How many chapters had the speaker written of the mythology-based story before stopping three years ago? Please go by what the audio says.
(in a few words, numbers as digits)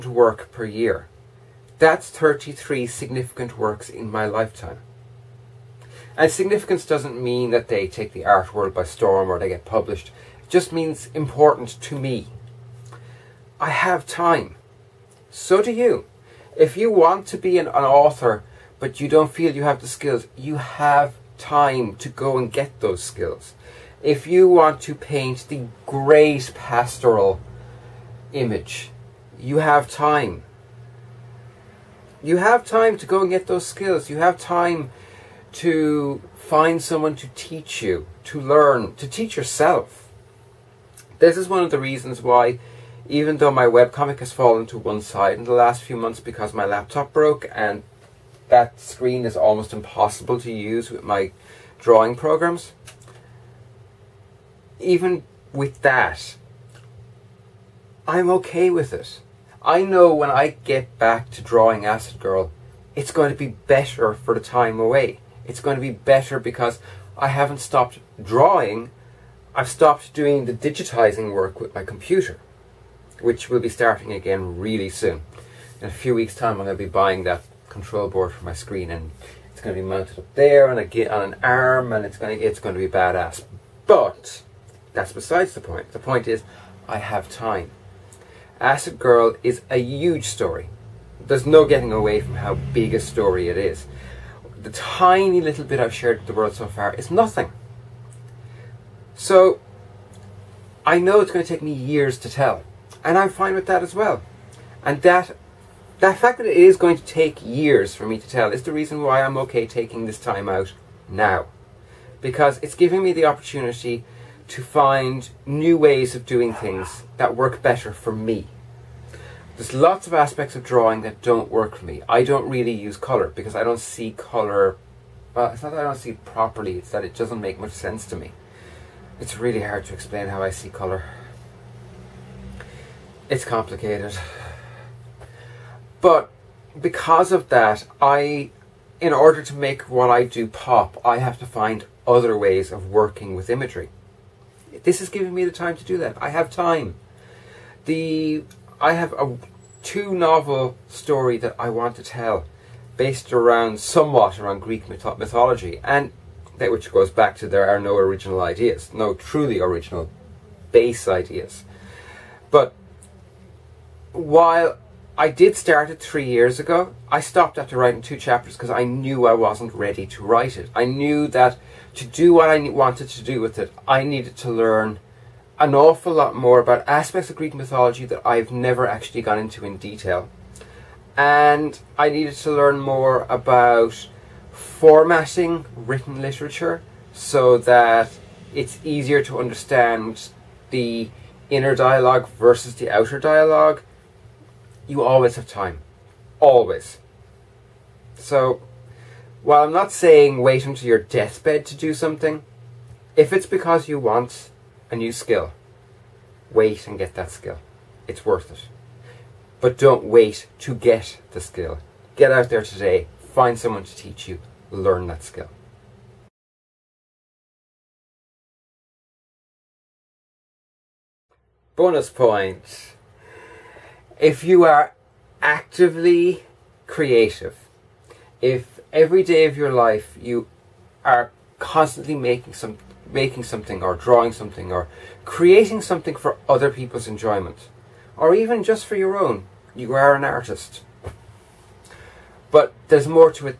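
2.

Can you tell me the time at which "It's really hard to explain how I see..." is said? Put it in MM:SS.
02:09.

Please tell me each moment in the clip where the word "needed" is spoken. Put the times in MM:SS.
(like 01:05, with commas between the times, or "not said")
02:54, 03:02.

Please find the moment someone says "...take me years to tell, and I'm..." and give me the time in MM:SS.
01:41.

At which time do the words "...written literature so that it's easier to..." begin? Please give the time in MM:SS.
03:05.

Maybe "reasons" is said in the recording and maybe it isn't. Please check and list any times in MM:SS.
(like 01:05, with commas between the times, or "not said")
00:41, 01:48.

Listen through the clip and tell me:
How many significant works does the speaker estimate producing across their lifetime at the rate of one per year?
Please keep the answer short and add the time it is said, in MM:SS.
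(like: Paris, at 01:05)
33, at 00:02.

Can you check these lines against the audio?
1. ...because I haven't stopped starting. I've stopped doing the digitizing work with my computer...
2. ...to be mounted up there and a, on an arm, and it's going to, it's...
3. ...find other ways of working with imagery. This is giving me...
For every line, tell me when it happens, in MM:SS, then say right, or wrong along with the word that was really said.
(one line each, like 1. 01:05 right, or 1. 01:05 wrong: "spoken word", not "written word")
1. 01:06 wrong: "drawing", not "starting"
2. 01:19 right
3. 02:21 right.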